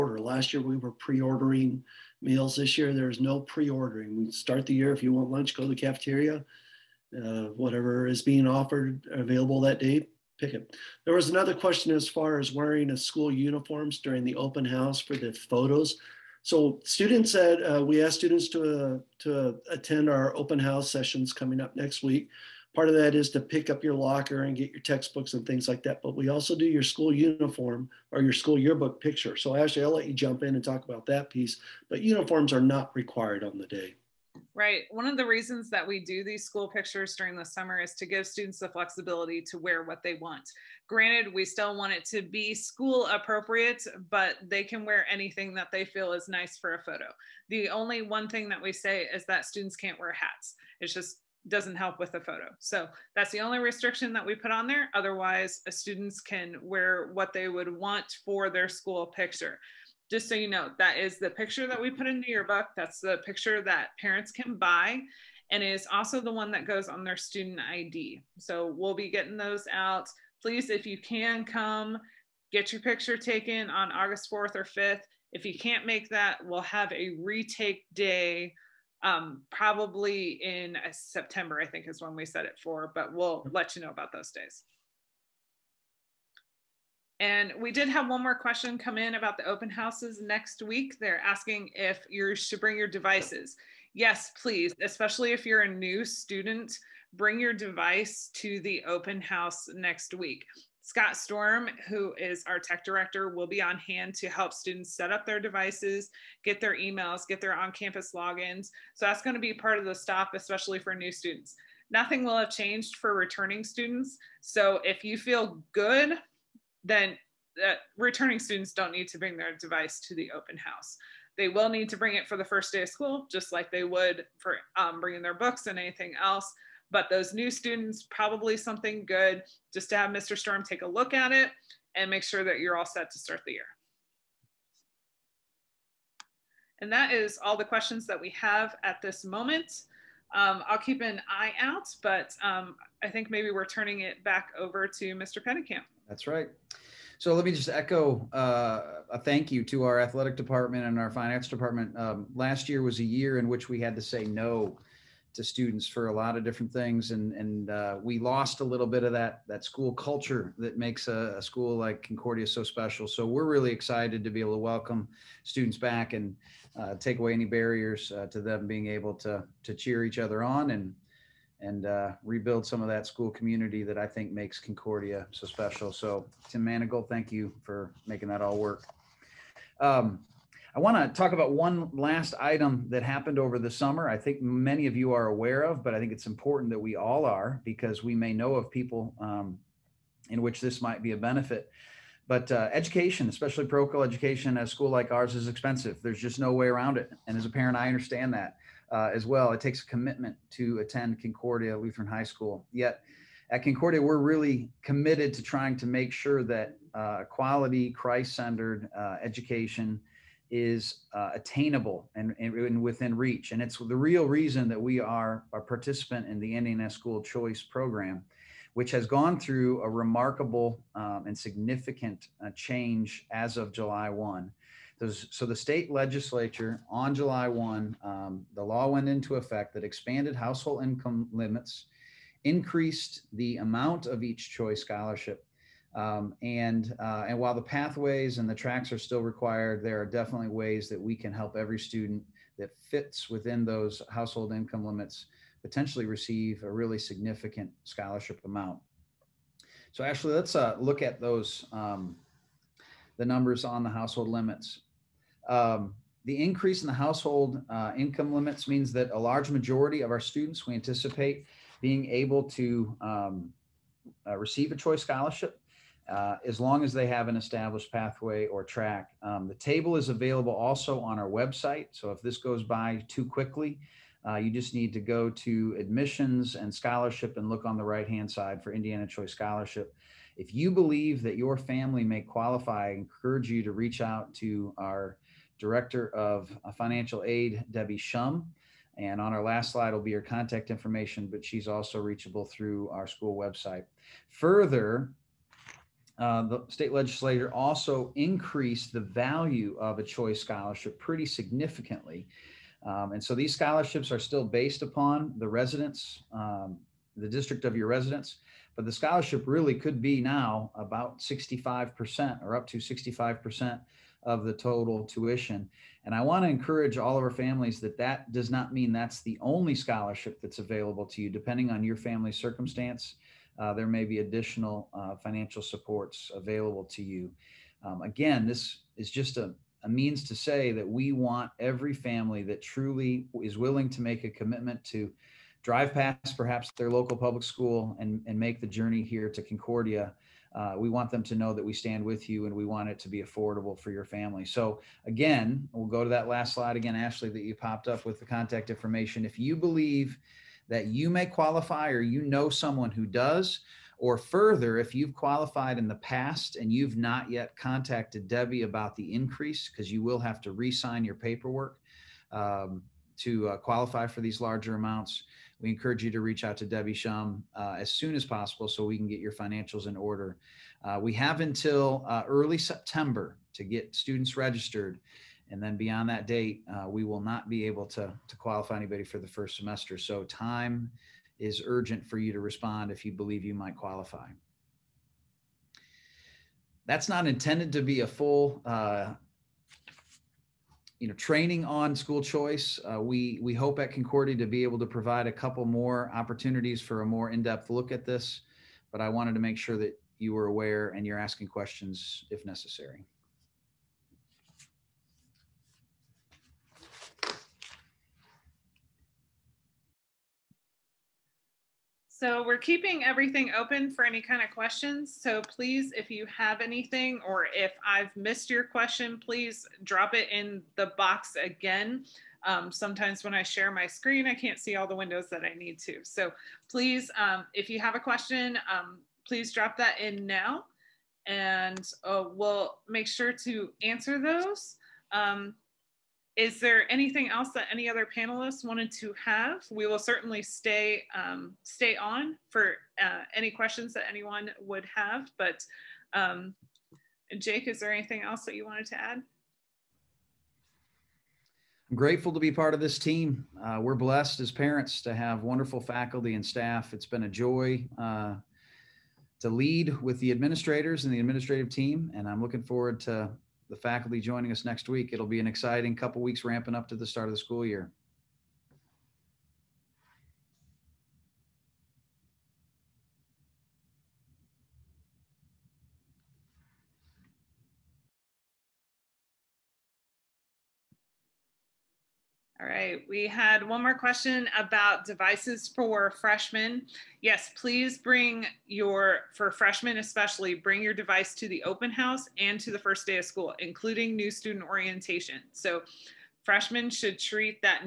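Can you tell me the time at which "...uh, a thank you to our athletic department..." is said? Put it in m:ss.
2:28.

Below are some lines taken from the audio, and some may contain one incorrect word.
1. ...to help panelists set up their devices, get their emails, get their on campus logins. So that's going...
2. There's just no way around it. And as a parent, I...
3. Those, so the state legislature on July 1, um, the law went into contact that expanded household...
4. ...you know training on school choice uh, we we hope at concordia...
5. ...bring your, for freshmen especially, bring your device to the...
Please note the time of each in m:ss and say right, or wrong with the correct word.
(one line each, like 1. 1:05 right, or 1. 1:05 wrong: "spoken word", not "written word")
1. 1:44 wrong: "students", not "panelists"
2. 3:16 right
3. 3:44 wrong: "effect", not "contact"
4. 6:31 right
5. 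8:07 right.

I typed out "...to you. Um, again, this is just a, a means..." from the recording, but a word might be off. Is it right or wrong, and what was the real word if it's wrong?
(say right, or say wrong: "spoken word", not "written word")
right.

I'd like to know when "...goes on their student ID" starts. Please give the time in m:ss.
1:06.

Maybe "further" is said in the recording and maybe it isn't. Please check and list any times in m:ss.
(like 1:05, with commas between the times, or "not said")
4:54, 5:54.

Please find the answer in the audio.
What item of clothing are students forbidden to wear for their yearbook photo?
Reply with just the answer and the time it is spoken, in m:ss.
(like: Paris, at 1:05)
Hats, at 0:50.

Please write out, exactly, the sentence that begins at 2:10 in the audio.
Storm take a look at it and make sure that you're all set to start the year.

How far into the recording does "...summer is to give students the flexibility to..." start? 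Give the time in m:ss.
0:37.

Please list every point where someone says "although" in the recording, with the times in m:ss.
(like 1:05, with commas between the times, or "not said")
not said.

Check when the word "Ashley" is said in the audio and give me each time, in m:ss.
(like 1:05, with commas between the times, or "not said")
0:29, 4:10, 5:46.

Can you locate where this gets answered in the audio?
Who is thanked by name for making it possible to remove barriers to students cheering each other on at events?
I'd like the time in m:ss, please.
2:56.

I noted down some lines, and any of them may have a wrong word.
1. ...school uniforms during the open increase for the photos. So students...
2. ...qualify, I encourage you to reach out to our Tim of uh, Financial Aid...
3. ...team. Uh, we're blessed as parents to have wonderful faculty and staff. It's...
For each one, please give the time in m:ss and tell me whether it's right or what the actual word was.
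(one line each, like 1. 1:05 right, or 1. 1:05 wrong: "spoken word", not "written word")
1. 0:12 wrong: "house", not "increase"
2. 4:42 wrong: "Director", not "Tim"
3. 7:32 right.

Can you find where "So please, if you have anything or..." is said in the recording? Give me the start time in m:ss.
6:55.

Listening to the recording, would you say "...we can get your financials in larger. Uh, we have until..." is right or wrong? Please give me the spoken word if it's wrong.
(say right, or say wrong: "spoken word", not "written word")
wrong: "order", not "larger".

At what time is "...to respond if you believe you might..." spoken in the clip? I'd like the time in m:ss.
6:22.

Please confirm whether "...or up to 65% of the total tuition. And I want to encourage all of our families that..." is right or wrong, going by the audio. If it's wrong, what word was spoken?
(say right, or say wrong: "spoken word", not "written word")
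right.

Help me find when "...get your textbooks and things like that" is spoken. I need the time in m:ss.
0:24.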